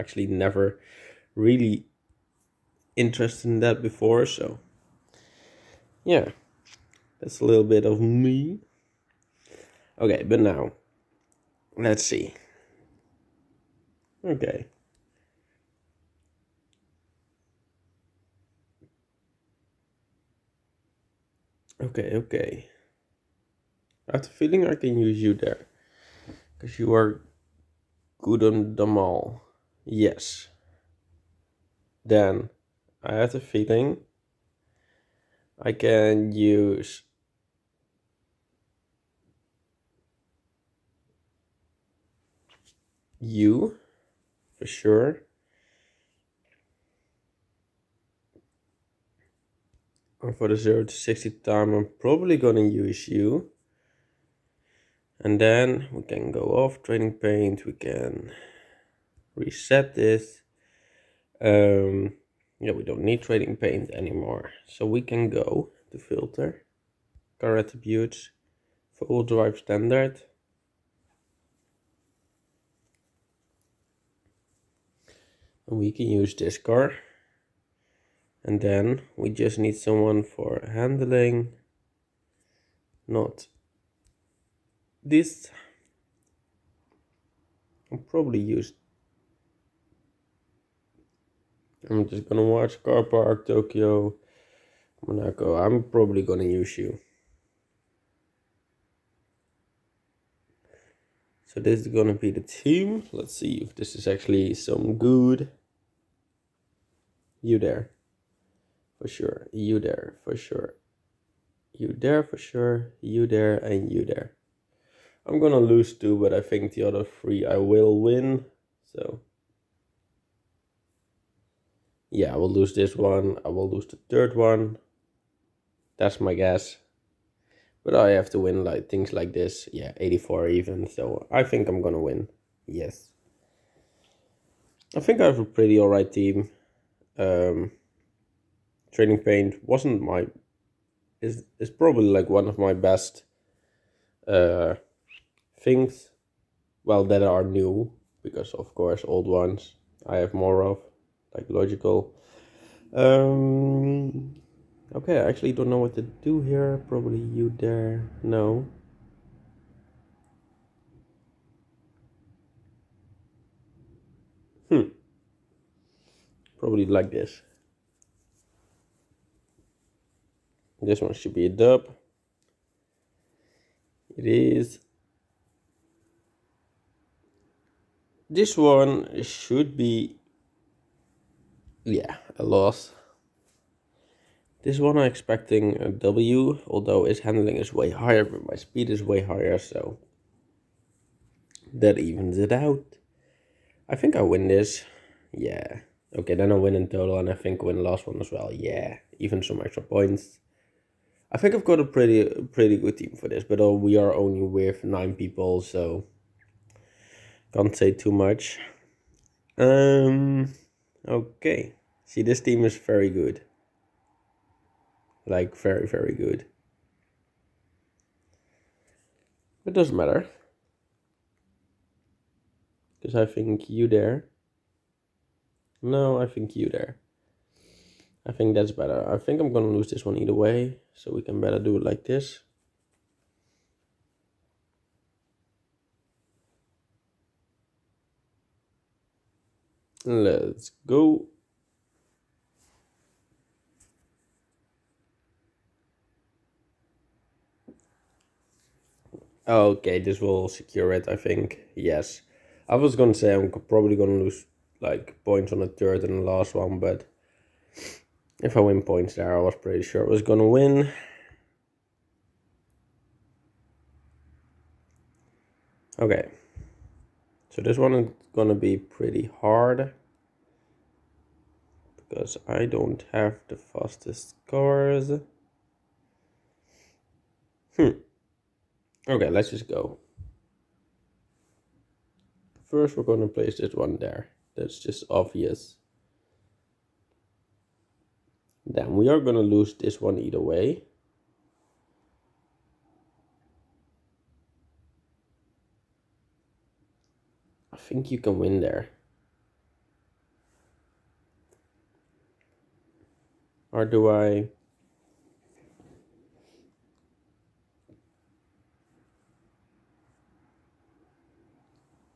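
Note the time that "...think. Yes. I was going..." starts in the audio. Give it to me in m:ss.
4:11.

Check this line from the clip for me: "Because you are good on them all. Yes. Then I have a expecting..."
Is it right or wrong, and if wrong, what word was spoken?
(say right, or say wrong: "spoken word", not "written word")
wrong: "feeling", not "expecting".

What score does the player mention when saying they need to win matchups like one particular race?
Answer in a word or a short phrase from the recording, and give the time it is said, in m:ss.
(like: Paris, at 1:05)
84, at 2:09.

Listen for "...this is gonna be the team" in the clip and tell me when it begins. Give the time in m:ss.
1:41.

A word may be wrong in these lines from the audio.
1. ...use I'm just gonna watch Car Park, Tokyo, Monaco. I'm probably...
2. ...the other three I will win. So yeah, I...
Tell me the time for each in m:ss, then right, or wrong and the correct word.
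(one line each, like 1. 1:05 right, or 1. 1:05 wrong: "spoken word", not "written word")
1. 1:28 right
2. 1:56 right.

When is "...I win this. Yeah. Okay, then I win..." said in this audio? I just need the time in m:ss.
3:14.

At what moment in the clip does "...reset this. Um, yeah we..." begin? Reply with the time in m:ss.
0:59.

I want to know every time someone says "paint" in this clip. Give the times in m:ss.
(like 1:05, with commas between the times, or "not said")
0:57, 1:03, 2:19.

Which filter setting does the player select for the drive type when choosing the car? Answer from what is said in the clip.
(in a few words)
full drive standard.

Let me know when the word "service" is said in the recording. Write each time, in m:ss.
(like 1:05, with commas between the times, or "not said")
not said.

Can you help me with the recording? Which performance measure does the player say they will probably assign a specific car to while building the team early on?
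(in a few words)
0 to 60 time.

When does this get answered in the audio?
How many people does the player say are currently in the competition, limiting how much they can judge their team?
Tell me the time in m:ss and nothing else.
3:24.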